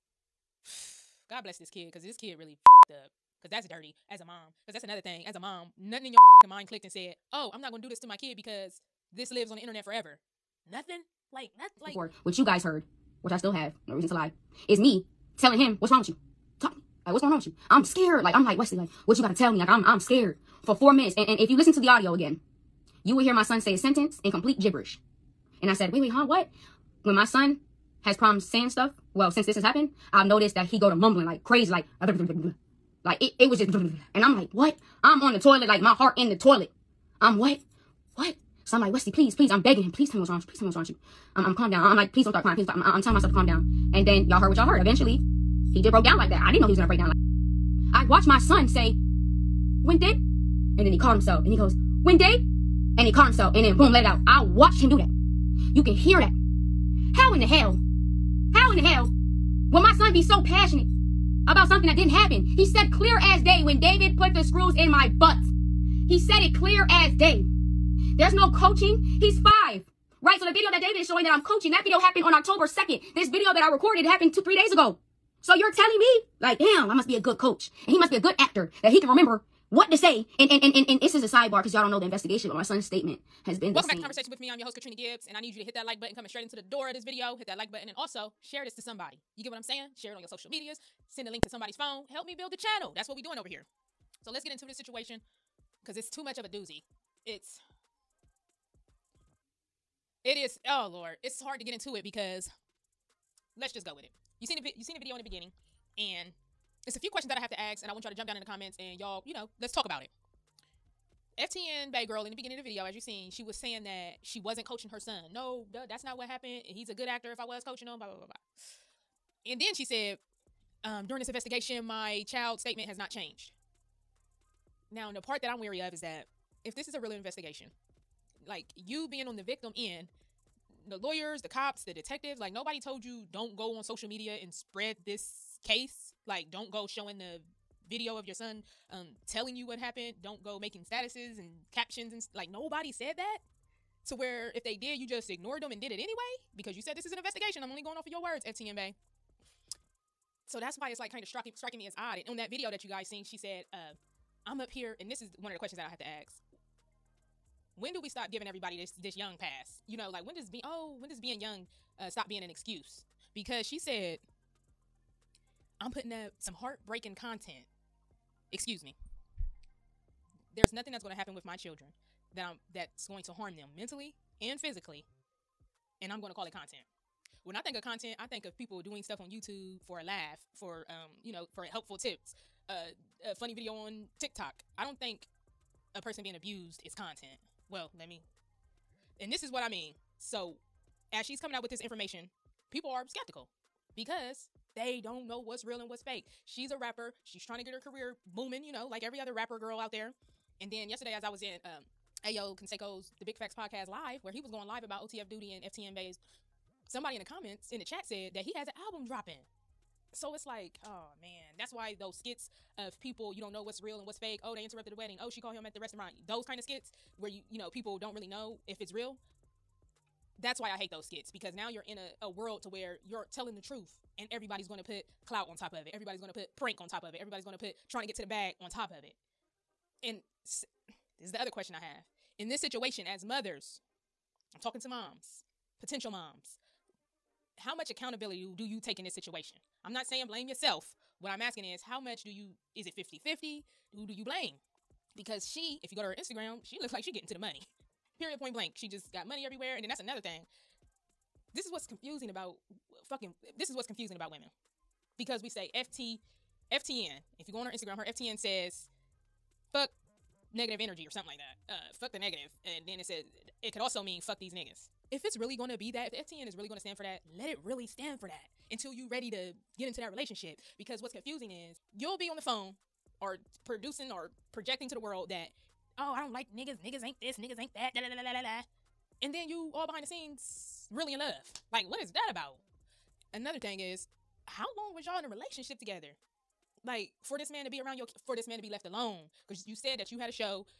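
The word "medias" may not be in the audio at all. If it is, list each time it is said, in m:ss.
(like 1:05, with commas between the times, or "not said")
1:30, 2:14.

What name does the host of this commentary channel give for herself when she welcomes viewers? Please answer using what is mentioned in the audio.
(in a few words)
Katrina Gibbs.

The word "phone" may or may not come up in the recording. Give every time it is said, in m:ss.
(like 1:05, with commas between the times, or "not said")
1:31, 4:32.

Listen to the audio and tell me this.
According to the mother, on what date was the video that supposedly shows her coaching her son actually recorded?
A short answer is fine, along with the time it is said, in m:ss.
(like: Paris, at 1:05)
October 2nd, at 1:12.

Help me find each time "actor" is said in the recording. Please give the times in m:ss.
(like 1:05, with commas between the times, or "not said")
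1:18, 1:57.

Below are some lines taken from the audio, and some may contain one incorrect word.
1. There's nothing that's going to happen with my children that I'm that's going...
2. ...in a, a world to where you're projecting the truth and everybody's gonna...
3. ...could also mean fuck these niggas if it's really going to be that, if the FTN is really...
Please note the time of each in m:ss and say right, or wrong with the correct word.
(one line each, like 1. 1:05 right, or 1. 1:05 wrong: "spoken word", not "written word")
1. 2:50 right
2. 3:41 wrong: "telling", not "projecting"
3. 4:23 right.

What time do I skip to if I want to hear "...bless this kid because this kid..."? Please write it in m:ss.
0:01.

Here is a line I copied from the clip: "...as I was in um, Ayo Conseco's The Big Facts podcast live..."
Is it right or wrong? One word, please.
right.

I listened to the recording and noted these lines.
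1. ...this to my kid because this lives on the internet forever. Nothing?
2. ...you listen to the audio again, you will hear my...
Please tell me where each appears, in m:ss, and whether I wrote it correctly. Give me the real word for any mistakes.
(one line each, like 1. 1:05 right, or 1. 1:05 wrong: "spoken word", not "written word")
1. 0:07 right
2. 0:21 right.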